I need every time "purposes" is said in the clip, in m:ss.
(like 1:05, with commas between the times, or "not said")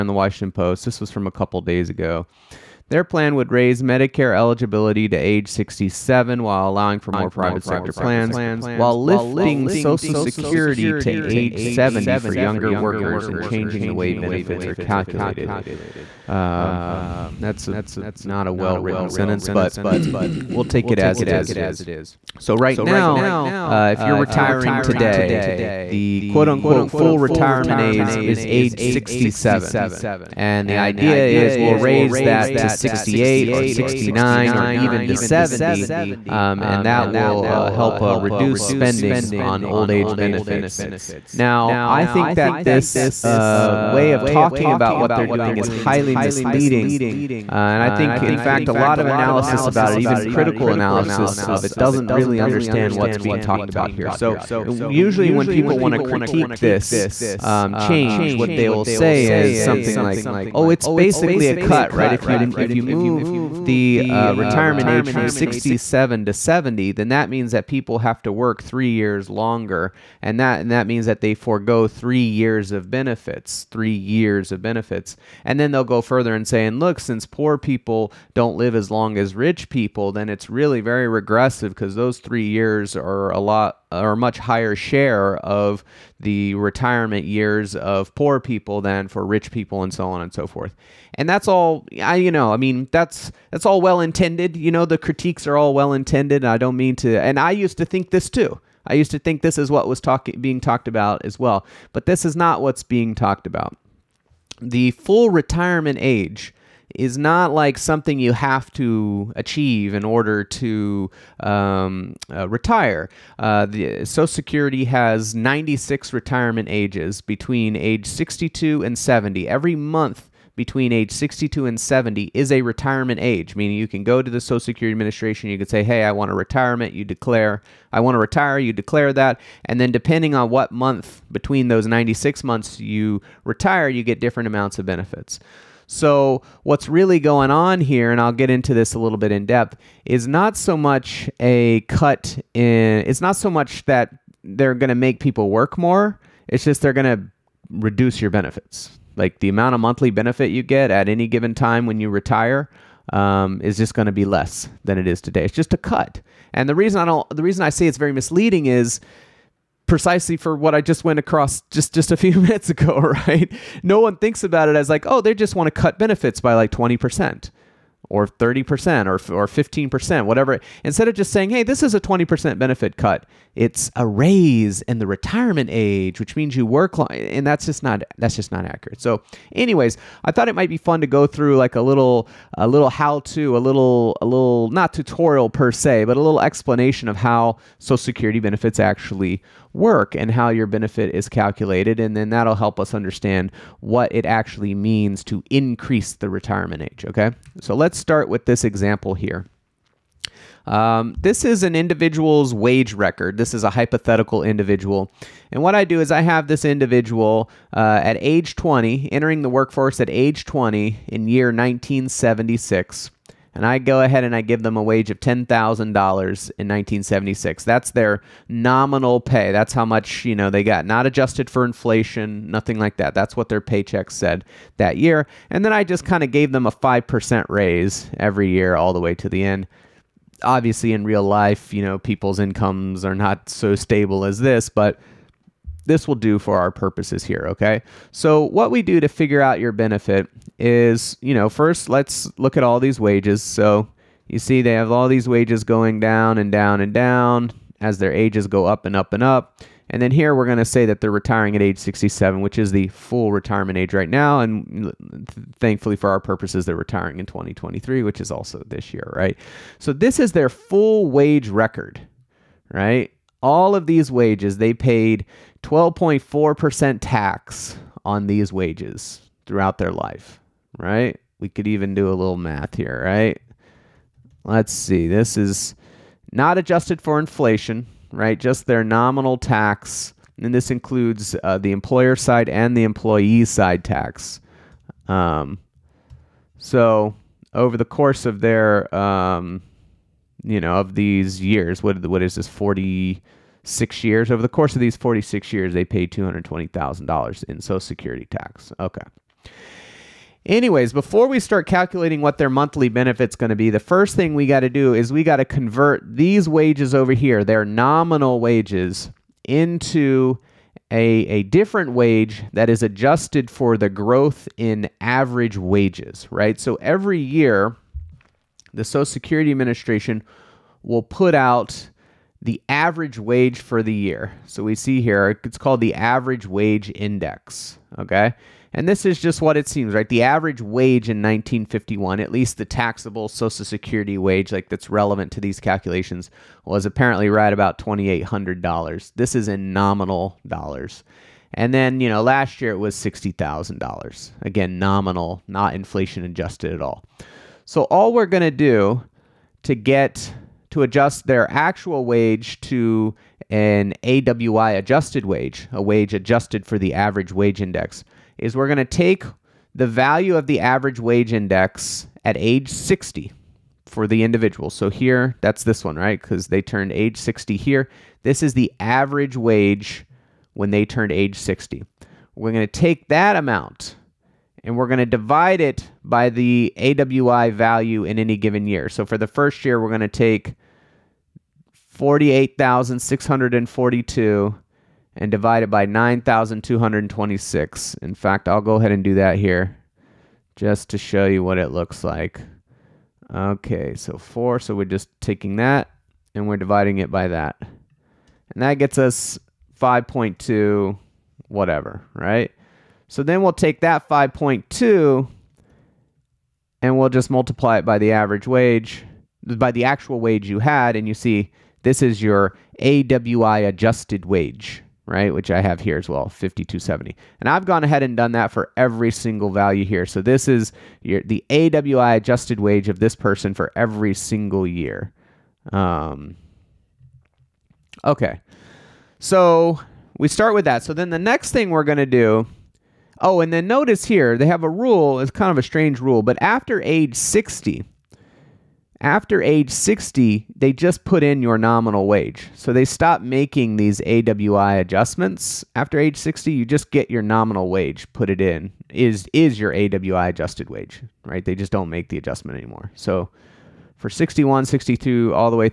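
3:56, 4:16.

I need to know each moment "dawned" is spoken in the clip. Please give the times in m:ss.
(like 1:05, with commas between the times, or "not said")
not said.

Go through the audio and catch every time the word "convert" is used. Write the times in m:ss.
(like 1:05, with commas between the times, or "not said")
5:05.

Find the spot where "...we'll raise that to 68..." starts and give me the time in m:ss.
0:31.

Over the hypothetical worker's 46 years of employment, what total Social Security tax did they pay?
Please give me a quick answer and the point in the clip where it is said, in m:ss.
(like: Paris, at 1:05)
$220,000, at 4:56.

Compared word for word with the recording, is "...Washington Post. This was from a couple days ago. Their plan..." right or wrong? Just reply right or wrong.
right.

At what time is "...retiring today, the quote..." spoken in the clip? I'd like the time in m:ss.
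0:24.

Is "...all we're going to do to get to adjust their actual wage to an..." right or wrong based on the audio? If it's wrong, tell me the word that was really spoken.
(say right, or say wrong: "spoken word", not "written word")
right.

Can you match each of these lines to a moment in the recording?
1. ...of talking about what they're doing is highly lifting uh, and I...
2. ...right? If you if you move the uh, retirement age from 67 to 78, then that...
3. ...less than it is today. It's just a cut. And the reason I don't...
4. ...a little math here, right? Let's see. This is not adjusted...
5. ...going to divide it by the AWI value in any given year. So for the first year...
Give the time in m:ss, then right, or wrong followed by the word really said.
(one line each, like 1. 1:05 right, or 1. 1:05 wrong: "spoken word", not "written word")
1. 0:44 wrong: "misleading", not "lifting"
2. 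1:01 wrong: "70", not "78"
3. 2:34 right
4. 4:32 right
5. 6:14 right.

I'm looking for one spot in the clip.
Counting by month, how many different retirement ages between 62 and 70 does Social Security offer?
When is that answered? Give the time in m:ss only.
1:55.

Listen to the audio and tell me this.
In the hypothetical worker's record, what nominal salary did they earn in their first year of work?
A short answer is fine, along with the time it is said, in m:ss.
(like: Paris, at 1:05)
$10,000, at 3:35.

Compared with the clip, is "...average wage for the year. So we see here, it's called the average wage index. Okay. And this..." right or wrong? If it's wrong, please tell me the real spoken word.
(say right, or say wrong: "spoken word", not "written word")
right.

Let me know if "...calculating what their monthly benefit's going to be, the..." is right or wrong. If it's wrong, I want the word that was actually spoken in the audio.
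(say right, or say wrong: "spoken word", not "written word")
right.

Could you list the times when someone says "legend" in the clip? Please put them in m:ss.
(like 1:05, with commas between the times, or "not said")
not said.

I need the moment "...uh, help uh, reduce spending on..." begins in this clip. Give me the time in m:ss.
0:37.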